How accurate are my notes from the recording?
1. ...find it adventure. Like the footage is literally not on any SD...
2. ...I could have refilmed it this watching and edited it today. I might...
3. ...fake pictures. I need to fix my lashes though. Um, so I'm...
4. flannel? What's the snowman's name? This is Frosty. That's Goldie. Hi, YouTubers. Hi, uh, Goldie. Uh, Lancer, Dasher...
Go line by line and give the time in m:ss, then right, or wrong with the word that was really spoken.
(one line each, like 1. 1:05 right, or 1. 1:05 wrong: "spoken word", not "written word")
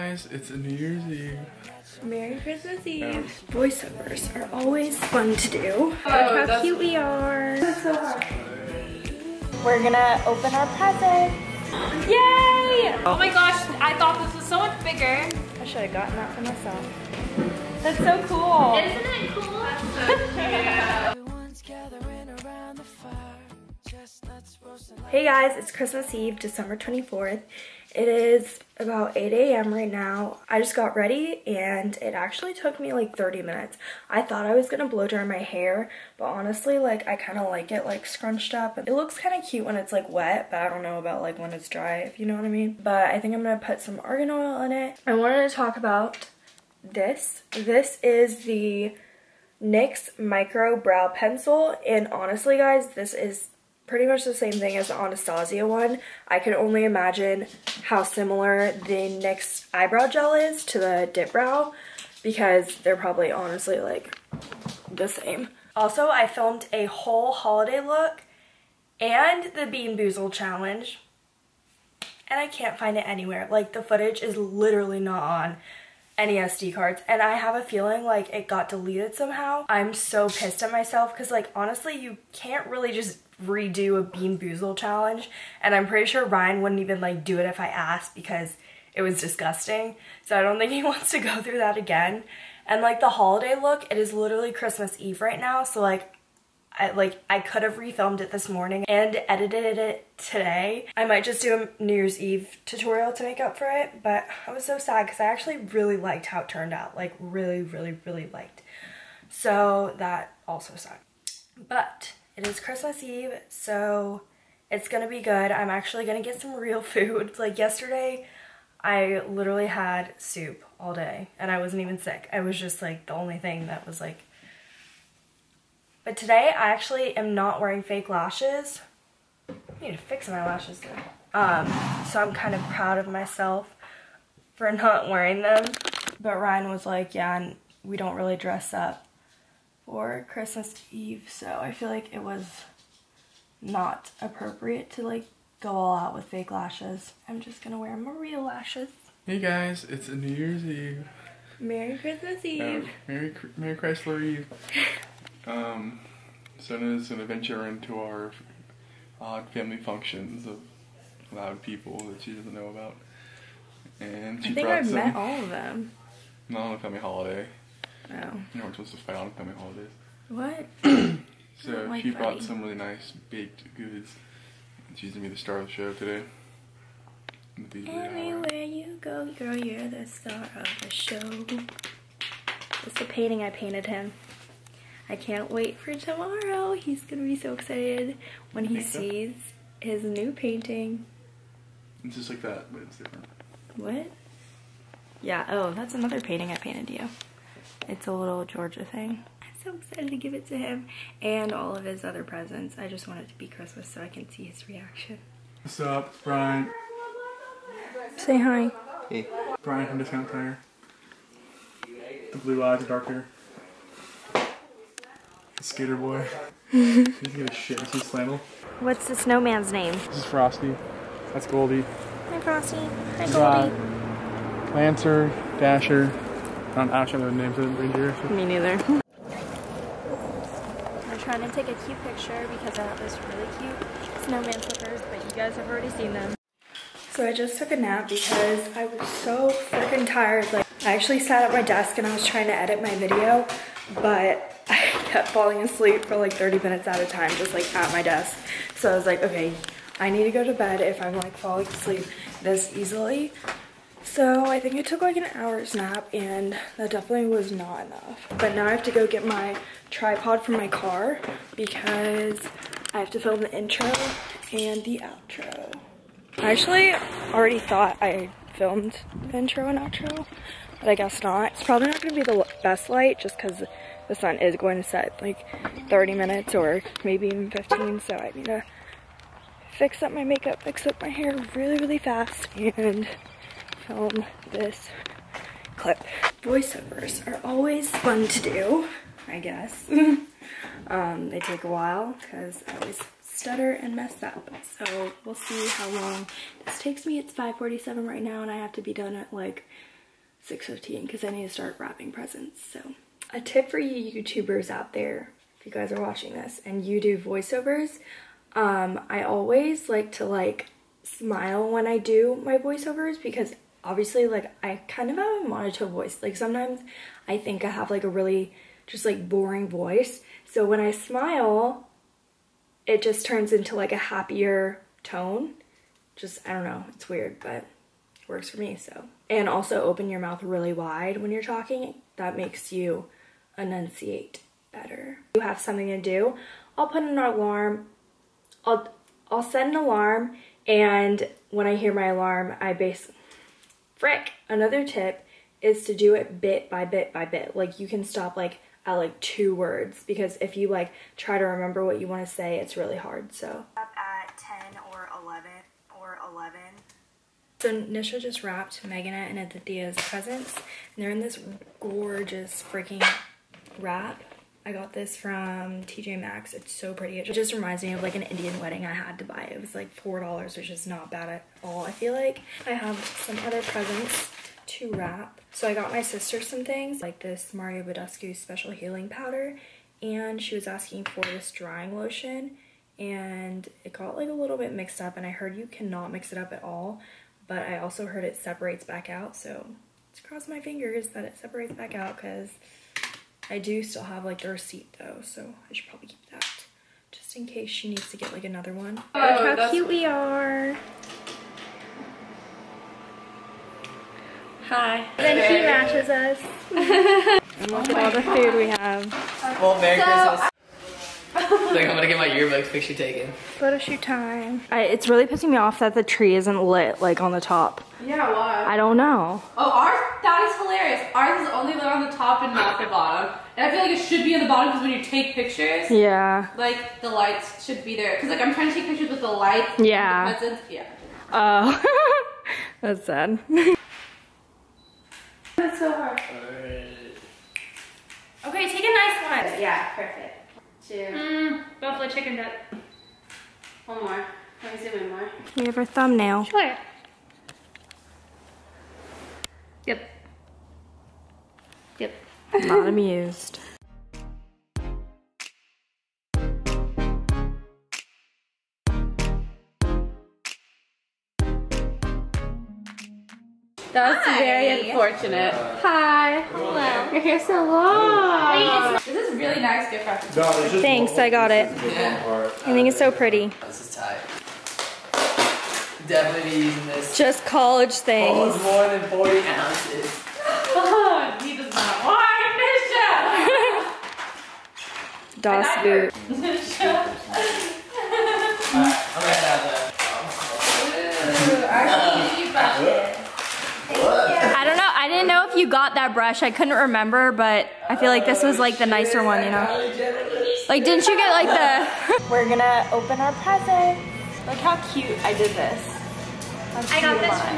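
1. 1:12 wrong: "anywhere", not "adventure"
2. 1:37 wrong: "morning", not "watching"
3. 2:07 wrong: "lashes", not "pictures"
4. 3:37 wrong: "Frosty", not "YouTubers".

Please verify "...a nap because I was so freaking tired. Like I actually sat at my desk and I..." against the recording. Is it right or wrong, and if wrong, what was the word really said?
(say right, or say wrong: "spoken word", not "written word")
right.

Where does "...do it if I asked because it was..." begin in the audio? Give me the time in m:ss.
1:27.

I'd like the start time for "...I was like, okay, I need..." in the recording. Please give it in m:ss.
4:08.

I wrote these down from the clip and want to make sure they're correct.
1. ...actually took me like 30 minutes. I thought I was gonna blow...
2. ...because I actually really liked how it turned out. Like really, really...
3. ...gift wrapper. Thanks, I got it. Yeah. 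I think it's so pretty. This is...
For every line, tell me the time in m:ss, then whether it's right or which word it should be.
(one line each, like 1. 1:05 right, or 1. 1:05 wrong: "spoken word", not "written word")
1. 0:32 right
2. 1:45 right
3. 7:49 right.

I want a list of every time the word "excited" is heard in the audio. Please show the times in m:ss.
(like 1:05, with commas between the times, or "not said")
3:07, 3:19.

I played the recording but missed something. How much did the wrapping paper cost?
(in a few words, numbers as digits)
$4.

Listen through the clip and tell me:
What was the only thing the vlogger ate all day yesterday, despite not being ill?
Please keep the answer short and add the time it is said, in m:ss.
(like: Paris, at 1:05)
Soup, at 2:00.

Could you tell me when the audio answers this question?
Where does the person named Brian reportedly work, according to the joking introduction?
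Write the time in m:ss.
3:29.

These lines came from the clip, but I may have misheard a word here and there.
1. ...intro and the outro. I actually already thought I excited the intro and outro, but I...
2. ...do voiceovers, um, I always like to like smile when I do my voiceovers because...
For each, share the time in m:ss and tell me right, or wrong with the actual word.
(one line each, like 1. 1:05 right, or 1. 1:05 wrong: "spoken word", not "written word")
1. 4:23 wrong: "filmed", not "excited"
2. 5:07 right.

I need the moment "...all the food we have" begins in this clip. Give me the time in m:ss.
6:48.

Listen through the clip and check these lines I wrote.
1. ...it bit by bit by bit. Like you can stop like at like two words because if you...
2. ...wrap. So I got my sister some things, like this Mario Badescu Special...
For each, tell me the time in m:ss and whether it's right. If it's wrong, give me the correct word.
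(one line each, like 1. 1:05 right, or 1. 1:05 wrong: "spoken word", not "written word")
1. 5:46 right
2. 6:14 right.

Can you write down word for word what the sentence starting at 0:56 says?
I can only imagine how similar the NYX eyebrow gel is to the dip brow because they're probably honestly like the same.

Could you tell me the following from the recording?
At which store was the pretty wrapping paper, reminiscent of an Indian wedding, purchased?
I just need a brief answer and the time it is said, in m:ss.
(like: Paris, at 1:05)
TJ Maxx, at 6:05.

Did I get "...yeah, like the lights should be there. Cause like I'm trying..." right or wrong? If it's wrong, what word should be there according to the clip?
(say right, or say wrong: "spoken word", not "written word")
right.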